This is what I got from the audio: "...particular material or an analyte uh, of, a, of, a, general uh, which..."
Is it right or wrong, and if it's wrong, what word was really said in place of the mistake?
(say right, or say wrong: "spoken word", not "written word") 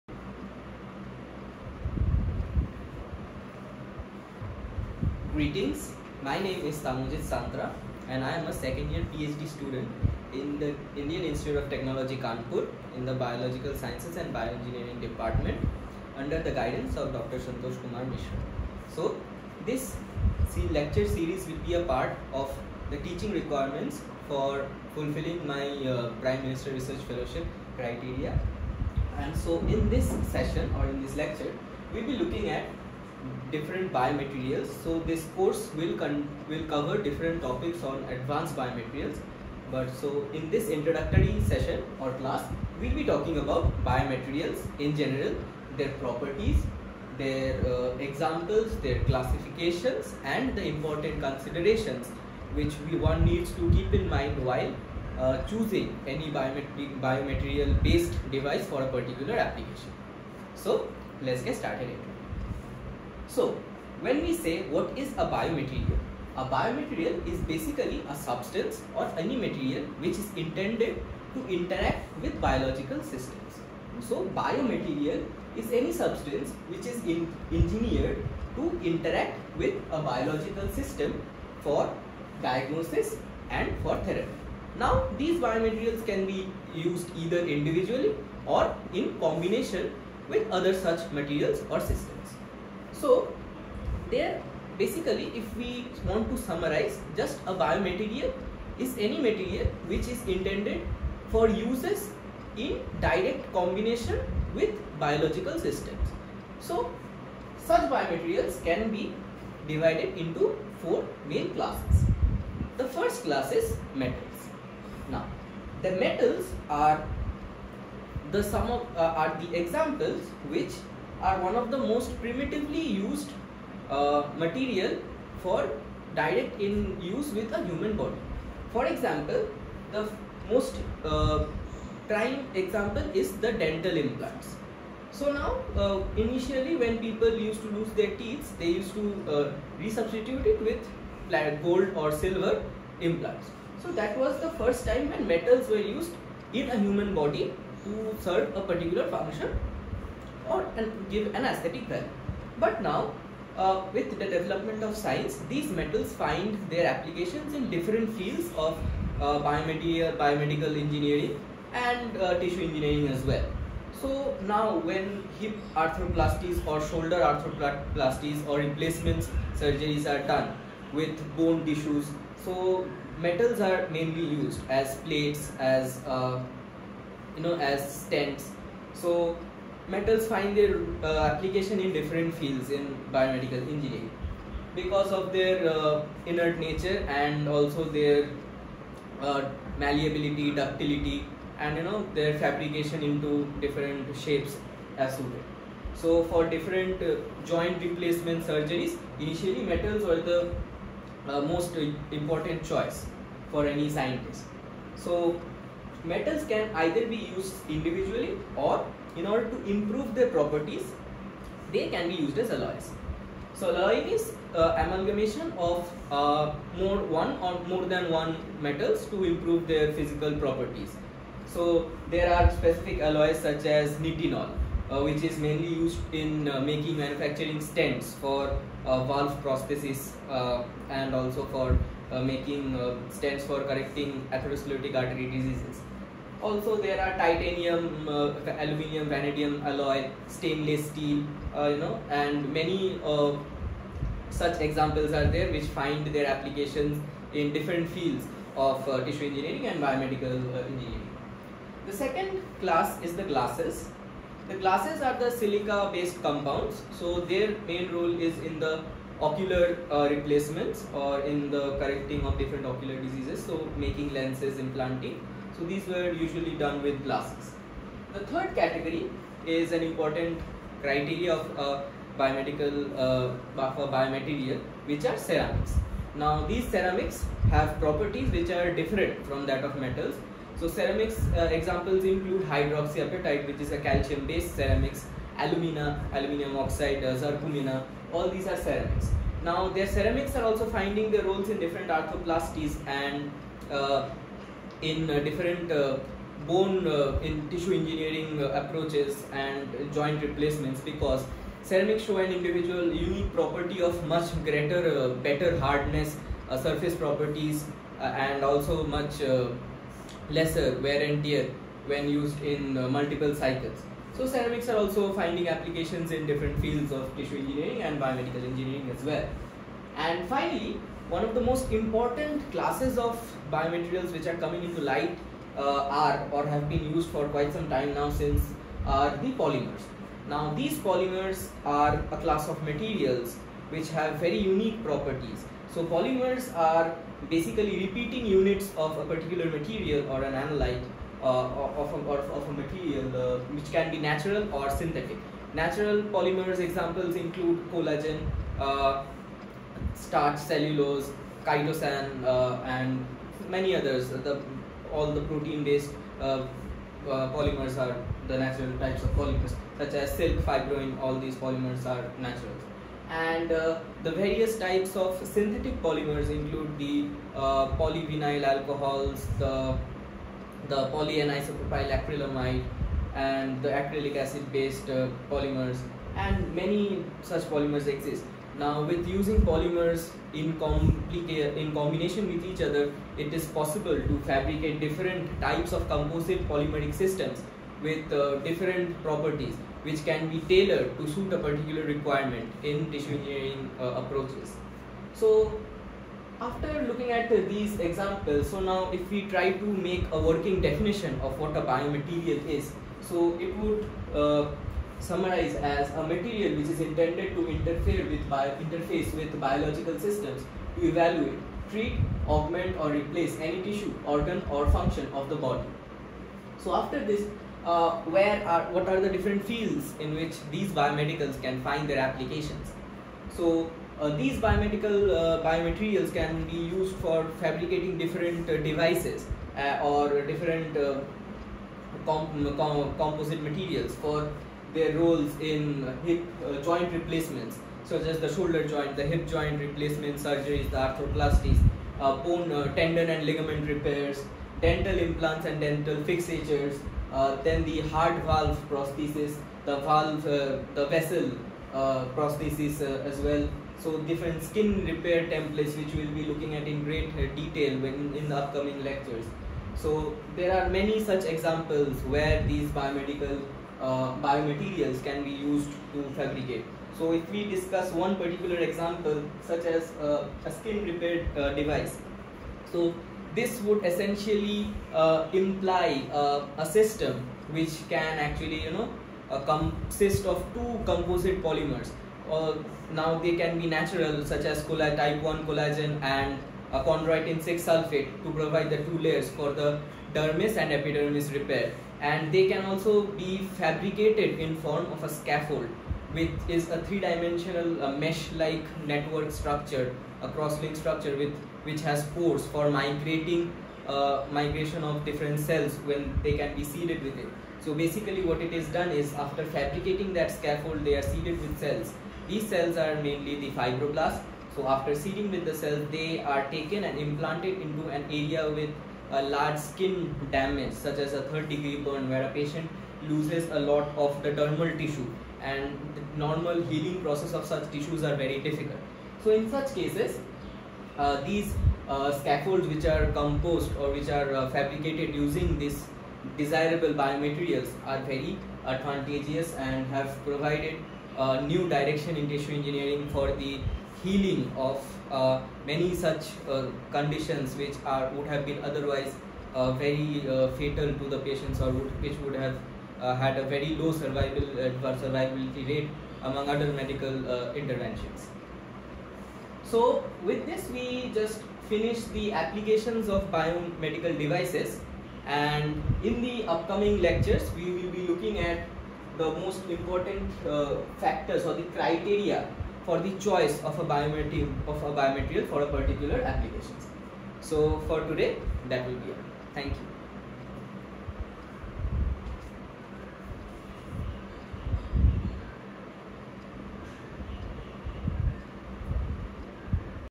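wrong: "material", not "general".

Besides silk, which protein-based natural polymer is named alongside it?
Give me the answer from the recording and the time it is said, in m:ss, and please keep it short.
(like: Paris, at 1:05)
fibroin, at 6:00.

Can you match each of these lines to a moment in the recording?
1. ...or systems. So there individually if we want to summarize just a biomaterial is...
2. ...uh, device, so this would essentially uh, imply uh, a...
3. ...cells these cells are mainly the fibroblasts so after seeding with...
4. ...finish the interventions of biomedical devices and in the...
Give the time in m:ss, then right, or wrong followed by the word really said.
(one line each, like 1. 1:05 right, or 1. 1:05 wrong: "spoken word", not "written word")
1. 1:31 wrong: "basically", not "individually"
2. 7:51 right
3. 8:31 right
4. 9:21 wrong: "applications", not "interventions".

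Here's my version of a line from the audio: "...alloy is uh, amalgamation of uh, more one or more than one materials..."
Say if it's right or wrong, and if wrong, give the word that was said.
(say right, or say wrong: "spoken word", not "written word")
wrong: "metals", not "materials".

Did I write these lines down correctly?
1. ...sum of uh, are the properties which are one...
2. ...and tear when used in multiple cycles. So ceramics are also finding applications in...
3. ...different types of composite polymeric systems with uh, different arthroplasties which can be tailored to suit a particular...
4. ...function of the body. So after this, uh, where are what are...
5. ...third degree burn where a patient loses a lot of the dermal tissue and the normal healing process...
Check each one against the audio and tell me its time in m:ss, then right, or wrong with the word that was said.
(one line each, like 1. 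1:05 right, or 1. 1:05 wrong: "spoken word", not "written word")
1. 1:58 wrong: "examples", not "properties"
2. 5:11 right
3. 6:24 wrong: "properties", not "arthroplasties"
4. 6:54 right
5. 8:41 right.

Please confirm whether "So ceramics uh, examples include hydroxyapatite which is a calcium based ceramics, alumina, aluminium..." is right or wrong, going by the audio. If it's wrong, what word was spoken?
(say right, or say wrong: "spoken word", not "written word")
right.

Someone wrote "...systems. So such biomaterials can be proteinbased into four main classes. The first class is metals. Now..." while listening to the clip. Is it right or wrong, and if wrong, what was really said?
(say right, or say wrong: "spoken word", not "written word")
wrong: "divided", not "proteinbased".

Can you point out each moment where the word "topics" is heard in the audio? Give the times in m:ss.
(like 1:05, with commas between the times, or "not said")
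0:37.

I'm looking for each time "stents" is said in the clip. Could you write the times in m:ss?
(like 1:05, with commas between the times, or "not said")
2:58, 3:47, 3:53.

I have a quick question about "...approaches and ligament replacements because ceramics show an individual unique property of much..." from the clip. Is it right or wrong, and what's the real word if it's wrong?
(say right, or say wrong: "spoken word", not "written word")
wrong: "joint", not "ligament".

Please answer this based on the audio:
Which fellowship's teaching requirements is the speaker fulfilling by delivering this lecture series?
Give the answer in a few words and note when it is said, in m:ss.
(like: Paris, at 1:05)
Prime Minister Research Fellowship, at 0:26.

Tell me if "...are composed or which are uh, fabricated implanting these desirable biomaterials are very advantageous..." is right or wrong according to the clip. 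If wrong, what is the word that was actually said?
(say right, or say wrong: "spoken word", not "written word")
wrong: "using", not "implanting".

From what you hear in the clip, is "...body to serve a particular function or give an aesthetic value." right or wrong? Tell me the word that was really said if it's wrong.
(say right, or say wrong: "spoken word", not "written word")
right.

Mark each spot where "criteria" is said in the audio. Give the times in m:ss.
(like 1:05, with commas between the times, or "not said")
0:27, 4:30, 9:31.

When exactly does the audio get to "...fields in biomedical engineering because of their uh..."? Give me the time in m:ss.
3:02.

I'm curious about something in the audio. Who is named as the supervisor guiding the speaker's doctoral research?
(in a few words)
Dr. Santosh Kumar Mishra.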